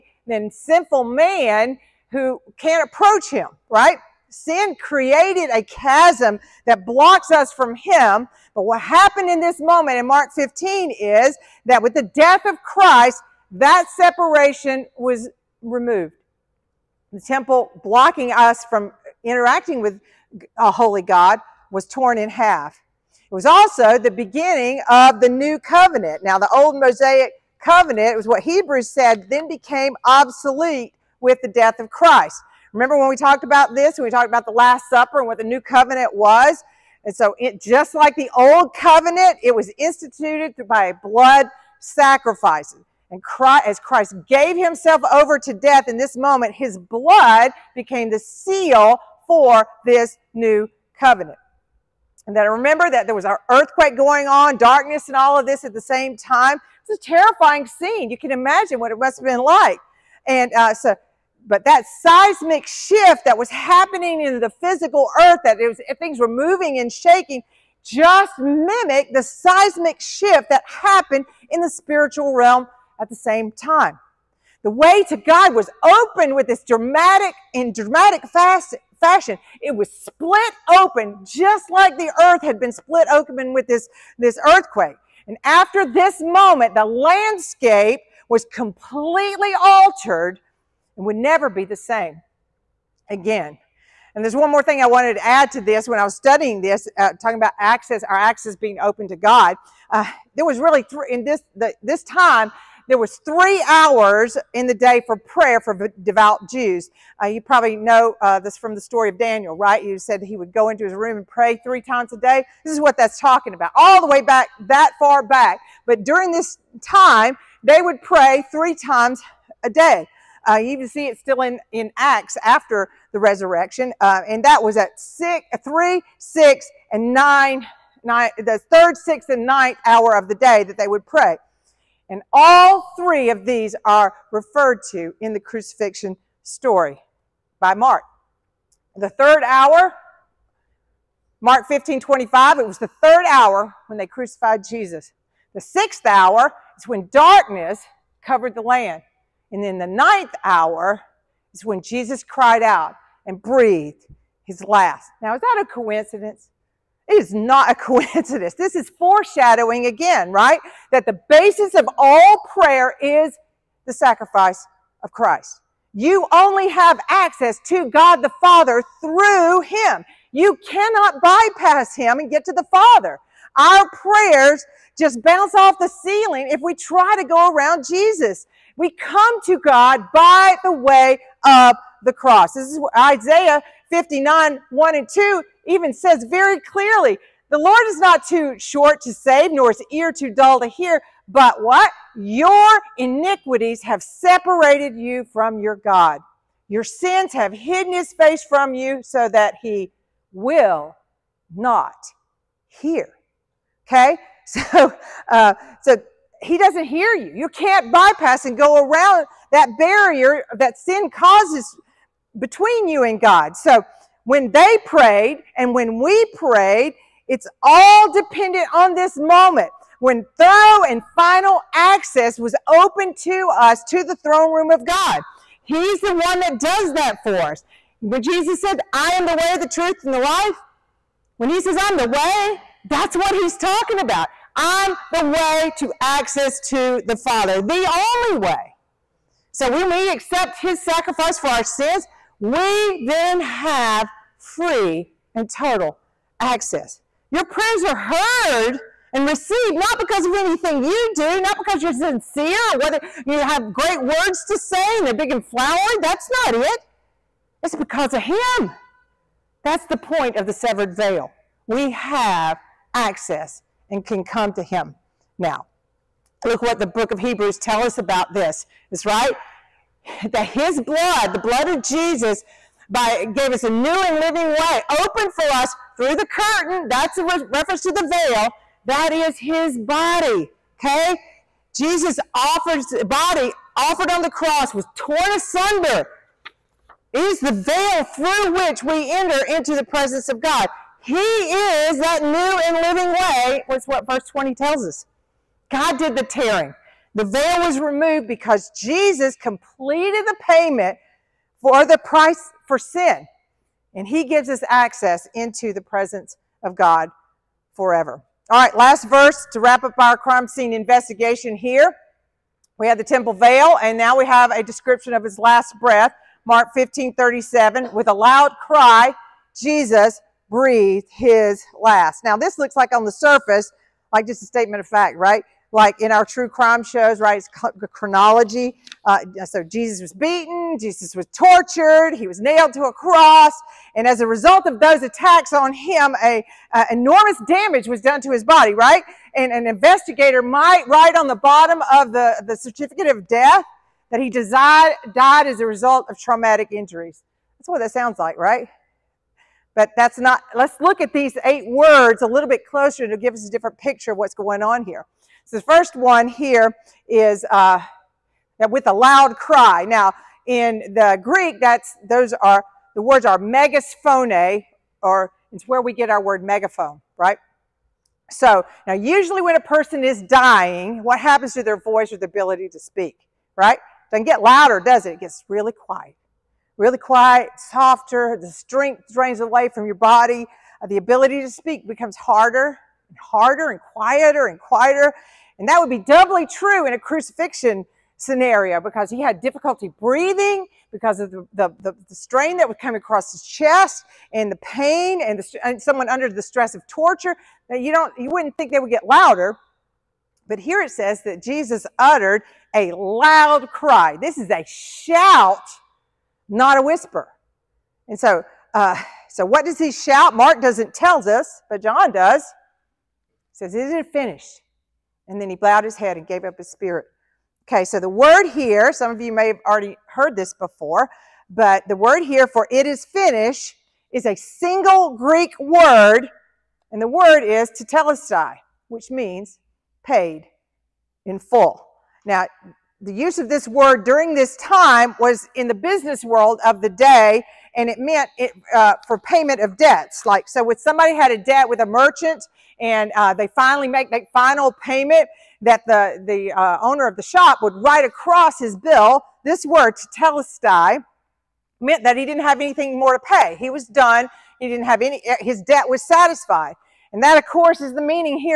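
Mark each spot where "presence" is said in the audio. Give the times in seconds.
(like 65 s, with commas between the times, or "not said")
289 s, 305 s.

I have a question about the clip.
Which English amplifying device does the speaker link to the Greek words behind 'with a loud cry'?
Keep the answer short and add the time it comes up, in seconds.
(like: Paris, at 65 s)
megasphone, at 363 s.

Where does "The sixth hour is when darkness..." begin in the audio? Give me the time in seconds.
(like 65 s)
145 s.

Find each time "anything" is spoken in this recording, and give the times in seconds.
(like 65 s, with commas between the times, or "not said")
250 s, 452 s.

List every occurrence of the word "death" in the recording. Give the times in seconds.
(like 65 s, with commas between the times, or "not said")
12 s, 31 s, 45 s, 343 s.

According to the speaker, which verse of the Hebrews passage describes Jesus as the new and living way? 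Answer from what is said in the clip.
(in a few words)
verse 20.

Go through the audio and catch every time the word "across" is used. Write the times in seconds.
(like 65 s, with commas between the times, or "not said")
392 s, 448 s.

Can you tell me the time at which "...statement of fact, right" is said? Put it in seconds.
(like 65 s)
324 s.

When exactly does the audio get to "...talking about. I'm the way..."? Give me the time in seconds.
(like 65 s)
233 s.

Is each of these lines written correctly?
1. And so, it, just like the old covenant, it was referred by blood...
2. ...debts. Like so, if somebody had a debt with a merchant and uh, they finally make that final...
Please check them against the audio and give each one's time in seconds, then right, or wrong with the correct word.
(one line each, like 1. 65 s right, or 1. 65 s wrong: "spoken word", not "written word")
1. 37 s wrong: "instituted", not "referred"
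2. 439 s right.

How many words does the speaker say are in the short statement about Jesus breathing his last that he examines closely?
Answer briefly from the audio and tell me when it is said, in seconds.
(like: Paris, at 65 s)
8, at 351 s.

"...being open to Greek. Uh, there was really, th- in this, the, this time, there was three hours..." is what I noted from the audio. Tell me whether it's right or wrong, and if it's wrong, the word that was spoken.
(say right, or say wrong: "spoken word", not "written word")
wrong: "God", not "Greek".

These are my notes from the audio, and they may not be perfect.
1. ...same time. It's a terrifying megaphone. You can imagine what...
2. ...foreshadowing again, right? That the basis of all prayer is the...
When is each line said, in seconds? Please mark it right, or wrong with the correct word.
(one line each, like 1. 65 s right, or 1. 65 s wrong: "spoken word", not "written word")
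1. 55 s wrong: "scene", not "megaphone"
2. 158 s right.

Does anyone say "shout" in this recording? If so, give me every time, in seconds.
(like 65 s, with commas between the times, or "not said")
404 s, 409 s.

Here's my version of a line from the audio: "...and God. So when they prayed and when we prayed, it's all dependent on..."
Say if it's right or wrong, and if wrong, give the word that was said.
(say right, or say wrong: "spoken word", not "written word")
right.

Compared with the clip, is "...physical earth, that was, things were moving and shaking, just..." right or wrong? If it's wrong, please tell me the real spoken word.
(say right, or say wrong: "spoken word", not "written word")
right.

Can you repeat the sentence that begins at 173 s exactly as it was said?
Our prayers just bounce off the ceiling if we try to go around Jesus.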